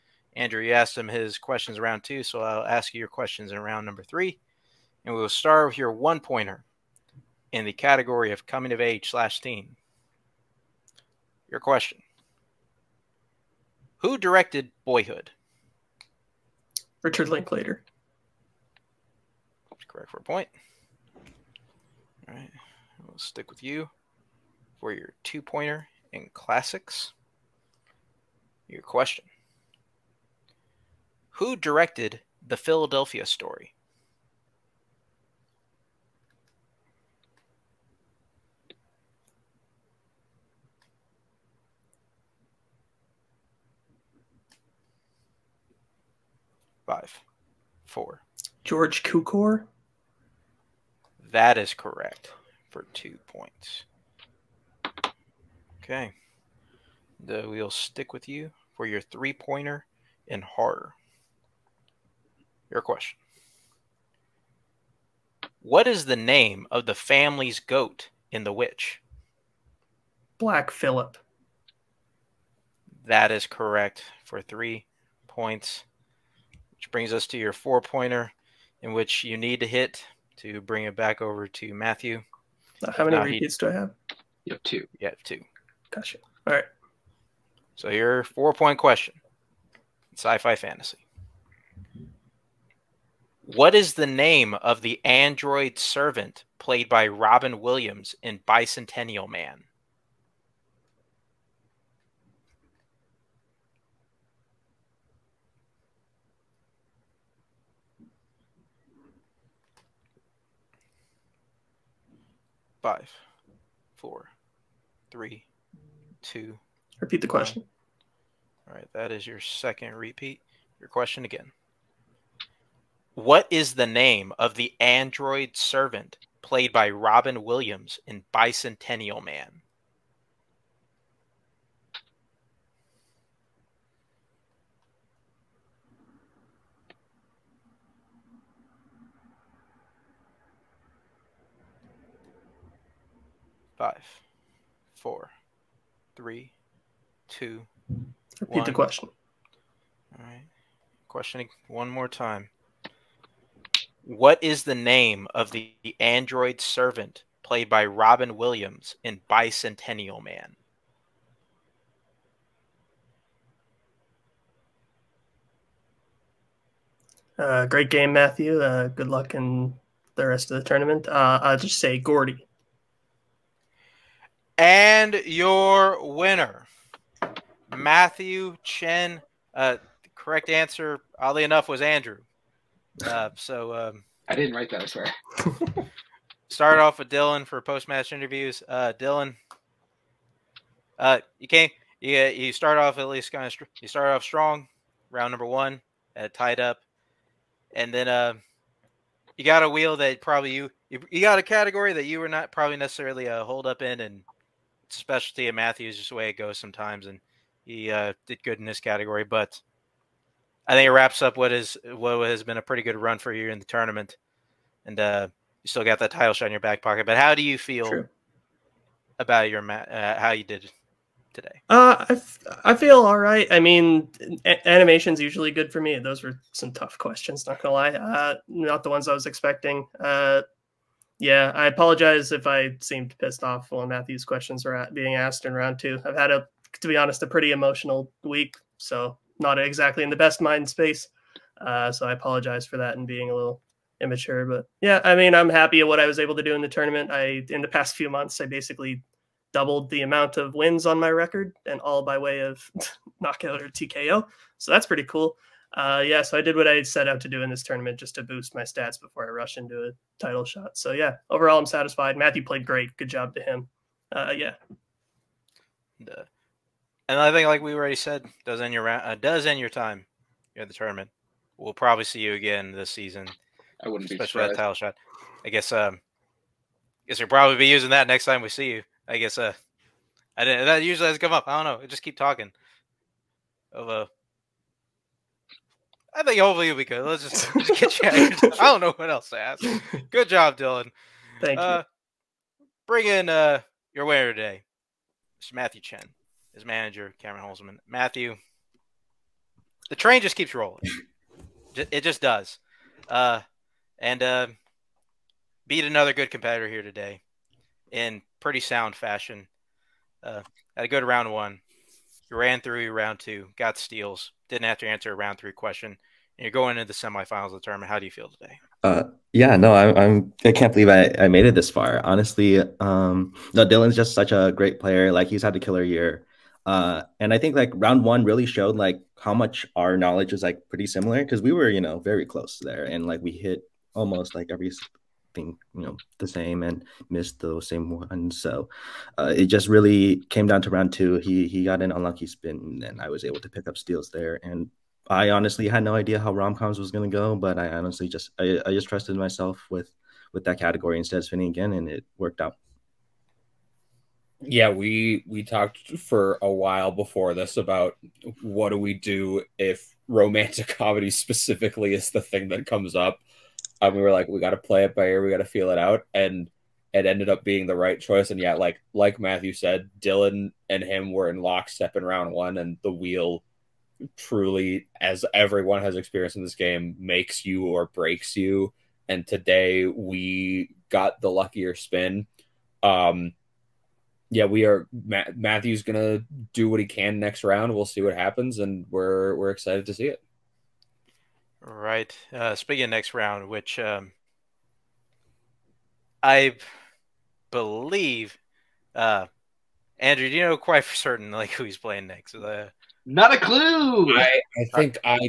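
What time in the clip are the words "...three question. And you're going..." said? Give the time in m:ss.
5:15.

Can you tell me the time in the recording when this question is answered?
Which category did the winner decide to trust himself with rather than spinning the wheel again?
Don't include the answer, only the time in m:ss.
5:46.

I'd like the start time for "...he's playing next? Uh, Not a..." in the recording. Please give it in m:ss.
6:41.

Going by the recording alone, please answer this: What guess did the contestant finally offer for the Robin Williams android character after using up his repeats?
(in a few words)
Gordy.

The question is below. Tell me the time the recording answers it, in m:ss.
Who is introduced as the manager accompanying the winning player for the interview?
4:57.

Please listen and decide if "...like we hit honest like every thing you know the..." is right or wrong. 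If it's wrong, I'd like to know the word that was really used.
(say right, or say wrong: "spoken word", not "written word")
wrong: "almost", not "honest".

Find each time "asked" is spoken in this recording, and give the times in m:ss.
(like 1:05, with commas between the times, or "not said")
0:00, 3:55.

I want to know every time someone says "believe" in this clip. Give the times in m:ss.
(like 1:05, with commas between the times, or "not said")
5:20, 6:37.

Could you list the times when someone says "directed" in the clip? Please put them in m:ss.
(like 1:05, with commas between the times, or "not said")
0:14, 0:31.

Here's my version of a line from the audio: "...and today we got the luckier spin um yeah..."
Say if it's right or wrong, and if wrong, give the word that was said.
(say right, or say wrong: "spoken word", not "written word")
right.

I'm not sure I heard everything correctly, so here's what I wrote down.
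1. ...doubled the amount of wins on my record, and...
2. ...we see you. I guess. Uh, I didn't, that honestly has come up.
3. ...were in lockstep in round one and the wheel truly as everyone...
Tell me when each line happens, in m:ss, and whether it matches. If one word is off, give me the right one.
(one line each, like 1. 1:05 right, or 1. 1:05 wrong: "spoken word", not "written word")
1. 4:09 right
2. 4:38 wrong: "usually", not "honestly"
3. 6:11 right.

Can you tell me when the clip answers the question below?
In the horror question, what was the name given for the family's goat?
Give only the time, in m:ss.
1:10.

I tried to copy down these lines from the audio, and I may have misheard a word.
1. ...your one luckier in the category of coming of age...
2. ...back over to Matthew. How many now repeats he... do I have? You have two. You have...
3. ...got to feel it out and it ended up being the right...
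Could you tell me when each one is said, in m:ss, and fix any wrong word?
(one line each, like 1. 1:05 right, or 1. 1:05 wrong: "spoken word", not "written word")
1. 0:05 wrong: "pointer", not "luckier"
2. 1:20 right
3. 6:05 right.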